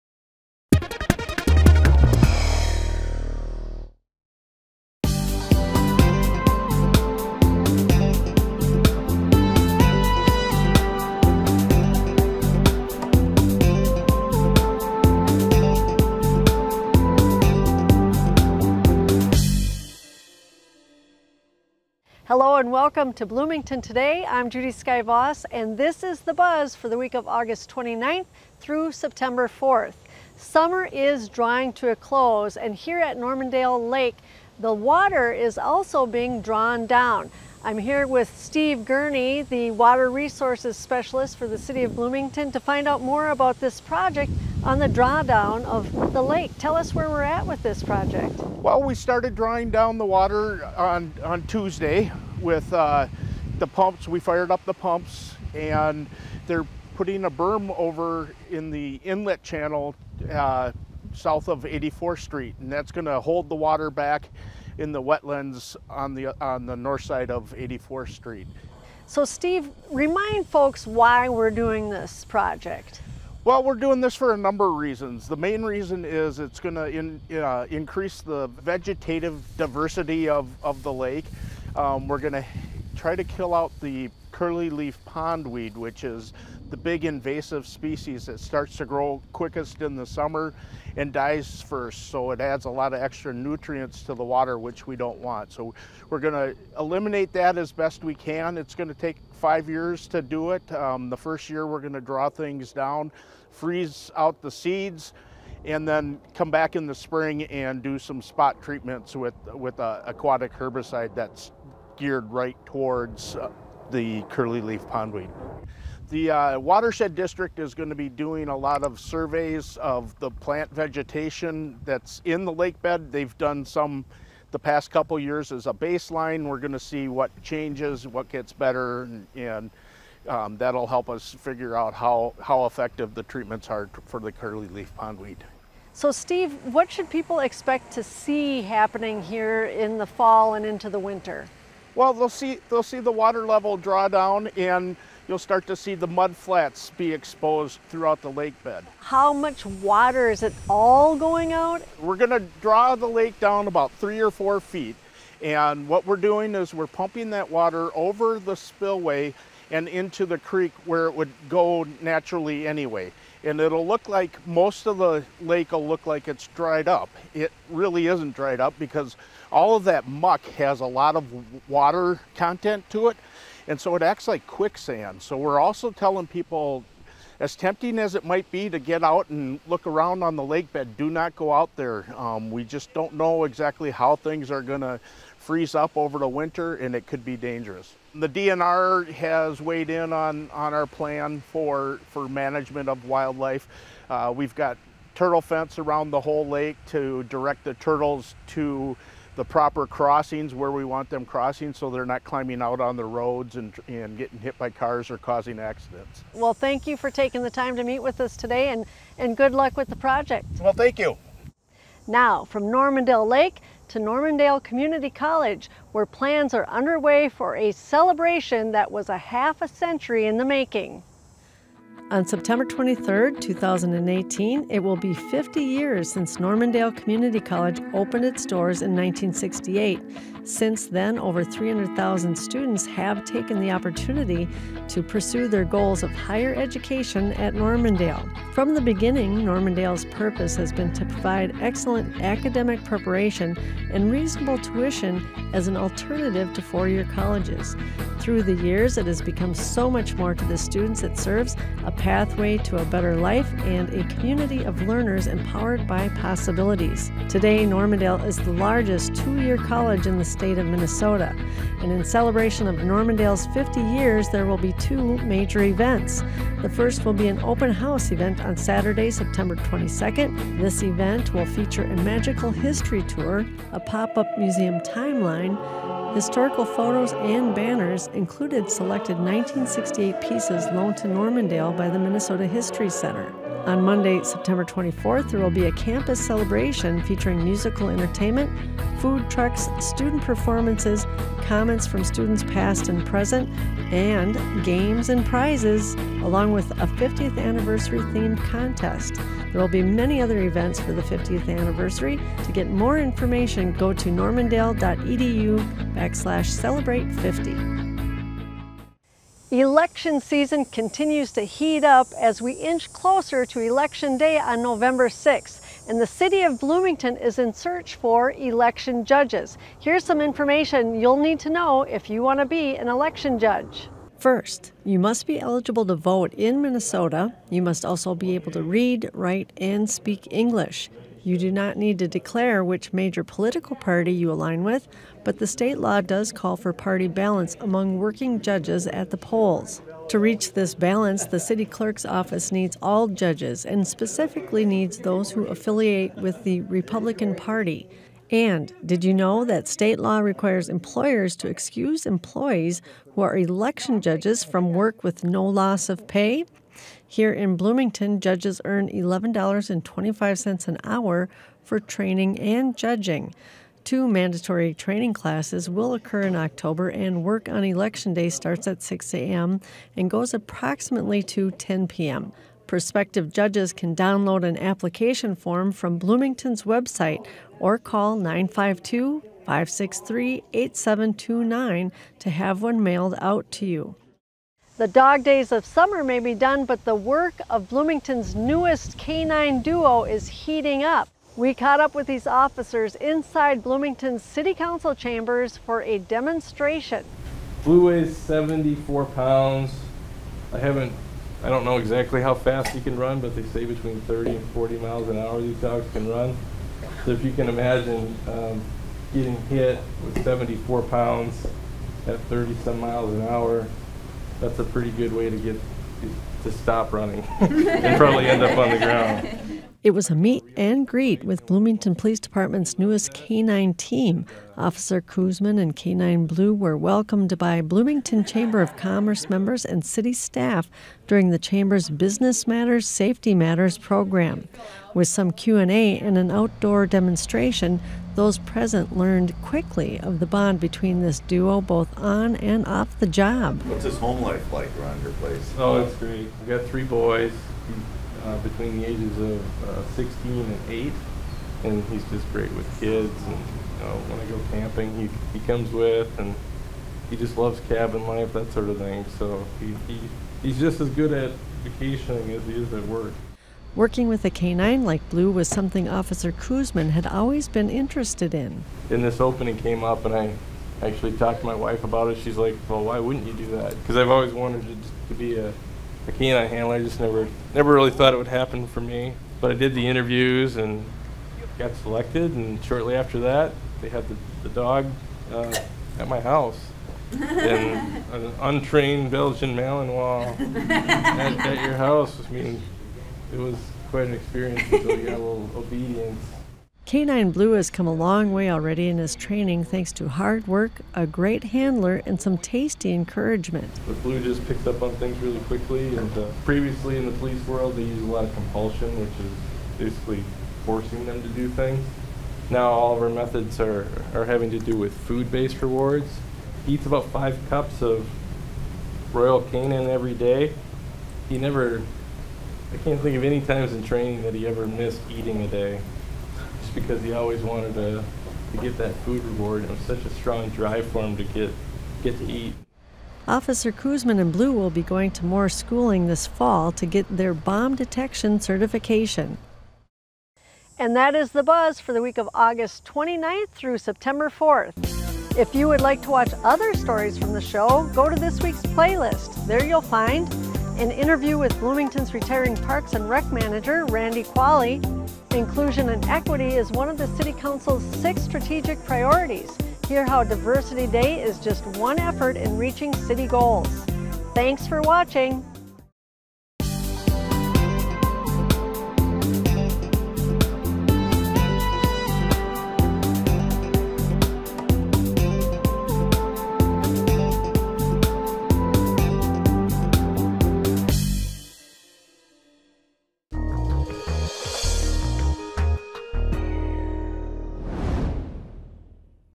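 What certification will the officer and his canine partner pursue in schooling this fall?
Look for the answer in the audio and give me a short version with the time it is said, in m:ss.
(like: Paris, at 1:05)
Bomb detection, at 8:57.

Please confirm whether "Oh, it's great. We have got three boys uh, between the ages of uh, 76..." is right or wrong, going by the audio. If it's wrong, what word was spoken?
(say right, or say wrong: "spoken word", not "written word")
wrong: "16", not "76".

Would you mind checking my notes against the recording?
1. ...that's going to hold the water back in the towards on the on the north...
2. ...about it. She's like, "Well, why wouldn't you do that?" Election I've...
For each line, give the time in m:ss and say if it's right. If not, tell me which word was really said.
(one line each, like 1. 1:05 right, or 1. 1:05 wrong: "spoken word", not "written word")
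1. 1:02 wrong: "wetlands", not "towards"
2. 7:51 wrong: "Because", not "Election".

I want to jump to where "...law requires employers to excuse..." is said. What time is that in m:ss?
5:49.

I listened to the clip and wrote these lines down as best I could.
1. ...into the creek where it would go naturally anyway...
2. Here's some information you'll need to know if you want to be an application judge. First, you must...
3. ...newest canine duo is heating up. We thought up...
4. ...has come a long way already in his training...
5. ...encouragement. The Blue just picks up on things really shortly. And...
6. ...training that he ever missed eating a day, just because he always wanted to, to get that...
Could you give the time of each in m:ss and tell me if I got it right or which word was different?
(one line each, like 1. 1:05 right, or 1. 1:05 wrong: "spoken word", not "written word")
1. 2:39 right
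2. 5:19 wrong: "election", not "application"
3. 6:28 wrong: "caught", not "thought"
4. 8:17 right
5. 8:22 wrong: "quickly", not "shortly"
6. 8:43 right.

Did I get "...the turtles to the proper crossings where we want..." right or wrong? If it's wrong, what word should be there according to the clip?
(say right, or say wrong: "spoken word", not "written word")
right.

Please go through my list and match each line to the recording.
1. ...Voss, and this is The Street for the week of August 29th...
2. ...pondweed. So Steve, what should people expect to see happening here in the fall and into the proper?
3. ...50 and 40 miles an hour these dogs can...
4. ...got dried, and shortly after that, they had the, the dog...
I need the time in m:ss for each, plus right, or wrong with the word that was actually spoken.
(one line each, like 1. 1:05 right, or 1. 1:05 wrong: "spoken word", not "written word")
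1. 0:25 wrong: "Buzz", not "Street"
2. 2:14 wrong: "winter", not "proper"
3. 6:44 wrong: "30", not "50"
4. 8:01 wrong: "selected", not "dried".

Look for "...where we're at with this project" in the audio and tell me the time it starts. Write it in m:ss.
0:46.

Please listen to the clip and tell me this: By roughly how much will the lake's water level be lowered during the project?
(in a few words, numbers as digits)
3 or 4 feet.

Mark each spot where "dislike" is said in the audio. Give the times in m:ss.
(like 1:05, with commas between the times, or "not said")
not said.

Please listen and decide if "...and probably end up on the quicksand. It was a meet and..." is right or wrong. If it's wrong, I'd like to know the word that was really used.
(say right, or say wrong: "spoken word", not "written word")
wrong: "ground", not "quicksand".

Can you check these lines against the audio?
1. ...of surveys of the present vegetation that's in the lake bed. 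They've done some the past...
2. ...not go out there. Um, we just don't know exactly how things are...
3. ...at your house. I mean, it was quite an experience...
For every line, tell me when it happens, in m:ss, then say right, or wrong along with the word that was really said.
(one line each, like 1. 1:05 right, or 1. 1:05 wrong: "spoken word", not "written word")
1. 1:58 wrong: "plant", not "present"
2. 3:01 right
3. 8:11 right.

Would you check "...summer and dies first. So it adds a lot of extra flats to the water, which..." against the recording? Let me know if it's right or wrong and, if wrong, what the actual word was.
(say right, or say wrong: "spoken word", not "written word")
wrong: "nutrients", not "flats".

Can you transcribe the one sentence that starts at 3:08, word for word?
The DNR has weighed in on, on our plan for, for management of wildlife.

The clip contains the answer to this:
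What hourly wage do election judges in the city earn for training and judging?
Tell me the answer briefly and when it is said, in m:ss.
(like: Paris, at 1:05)
$11.25, at 5:58.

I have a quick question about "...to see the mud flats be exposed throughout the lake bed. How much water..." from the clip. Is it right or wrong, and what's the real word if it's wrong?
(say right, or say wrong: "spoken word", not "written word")
right.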